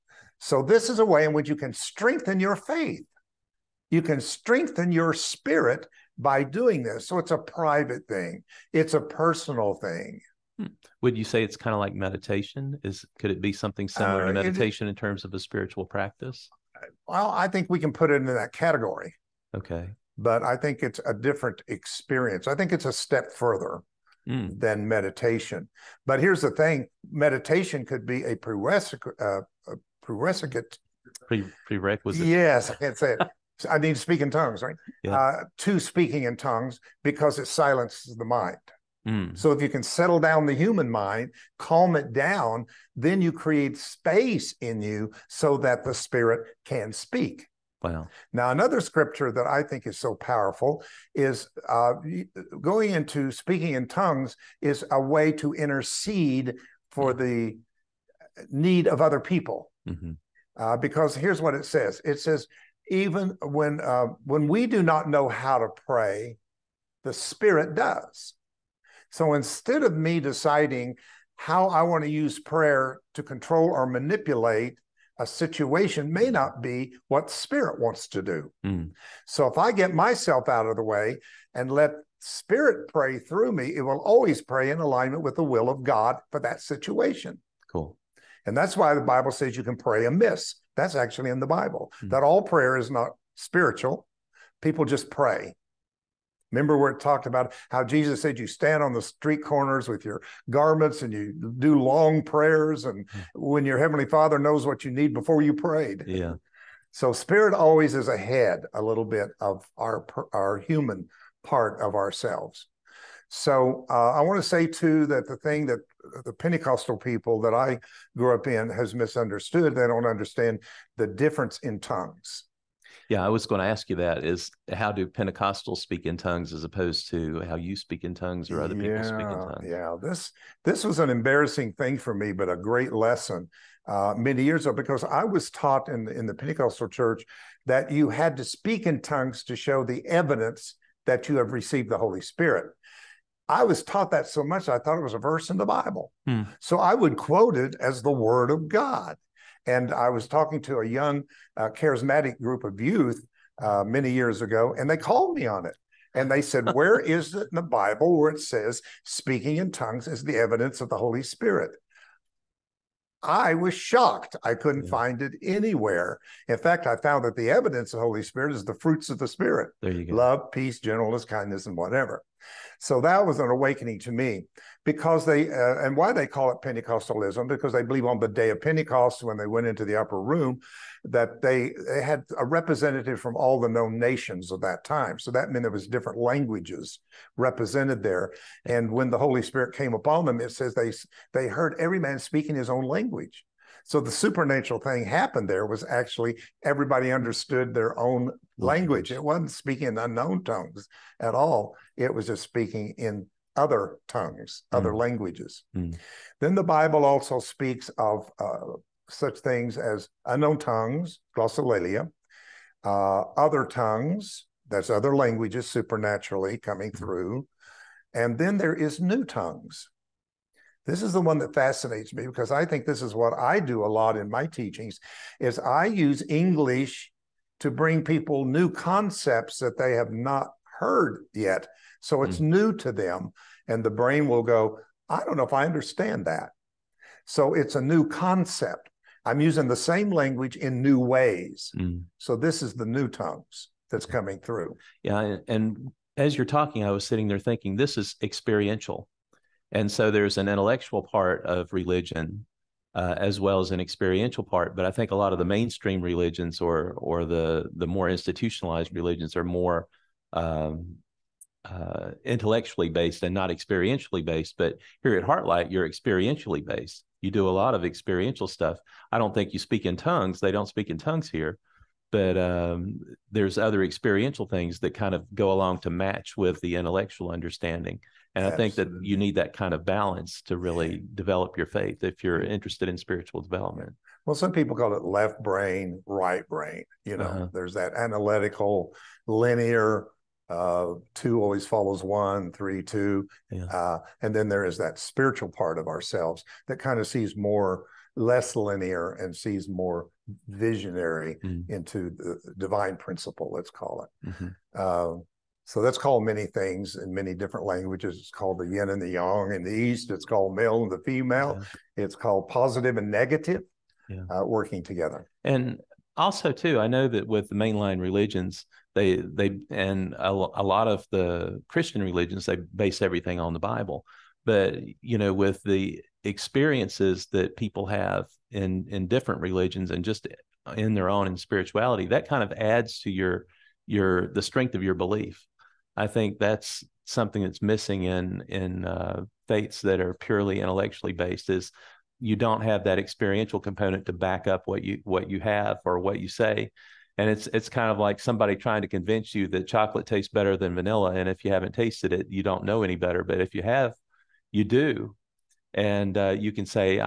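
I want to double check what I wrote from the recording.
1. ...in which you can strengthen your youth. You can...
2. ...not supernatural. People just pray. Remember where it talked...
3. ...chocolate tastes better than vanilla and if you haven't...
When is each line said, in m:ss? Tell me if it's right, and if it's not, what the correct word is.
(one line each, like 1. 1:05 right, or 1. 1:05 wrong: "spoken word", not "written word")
1. 0:01 wrong: "faith", not "youth"
2. 1:32 wrong: "spiritual", not "supernatural"
3. 5:49 right.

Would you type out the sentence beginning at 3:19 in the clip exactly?
It wasn't speaking in unknown tongues at all.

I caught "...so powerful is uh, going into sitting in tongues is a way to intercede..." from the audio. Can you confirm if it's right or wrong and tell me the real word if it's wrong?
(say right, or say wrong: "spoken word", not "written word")
wrong: "speaking", not "sitting".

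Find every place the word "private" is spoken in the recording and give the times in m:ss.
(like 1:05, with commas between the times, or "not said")
0:07.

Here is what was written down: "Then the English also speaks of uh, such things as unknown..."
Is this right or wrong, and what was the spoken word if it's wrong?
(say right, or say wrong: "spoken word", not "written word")
wrong: "Bible", not "English".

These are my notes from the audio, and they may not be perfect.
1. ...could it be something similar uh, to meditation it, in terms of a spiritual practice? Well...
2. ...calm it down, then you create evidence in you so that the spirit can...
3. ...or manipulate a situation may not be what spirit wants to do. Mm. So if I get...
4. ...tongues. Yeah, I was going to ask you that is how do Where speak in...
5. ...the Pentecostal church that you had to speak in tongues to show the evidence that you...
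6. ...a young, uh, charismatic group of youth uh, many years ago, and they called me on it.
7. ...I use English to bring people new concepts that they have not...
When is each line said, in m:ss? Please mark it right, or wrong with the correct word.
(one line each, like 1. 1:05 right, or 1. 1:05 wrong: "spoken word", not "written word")
1. 0:13 right
2. 0:41 wrong: "space", not "evidence"
3. 1:13 right
4. 2:01 wrong: "Pentecostals", not "Where"
5. 2:16 right
6. 2:30 right
7. 3:45 right.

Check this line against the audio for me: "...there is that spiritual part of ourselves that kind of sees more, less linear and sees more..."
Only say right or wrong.
right.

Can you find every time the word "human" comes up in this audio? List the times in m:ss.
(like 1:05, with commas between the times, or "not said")
0:40, 1:50.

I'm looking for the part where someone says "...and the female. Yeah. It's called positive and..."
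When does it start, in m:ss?
5:10.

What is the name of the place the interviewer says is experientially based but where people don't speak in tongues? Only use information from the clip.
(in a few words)
Heartlight.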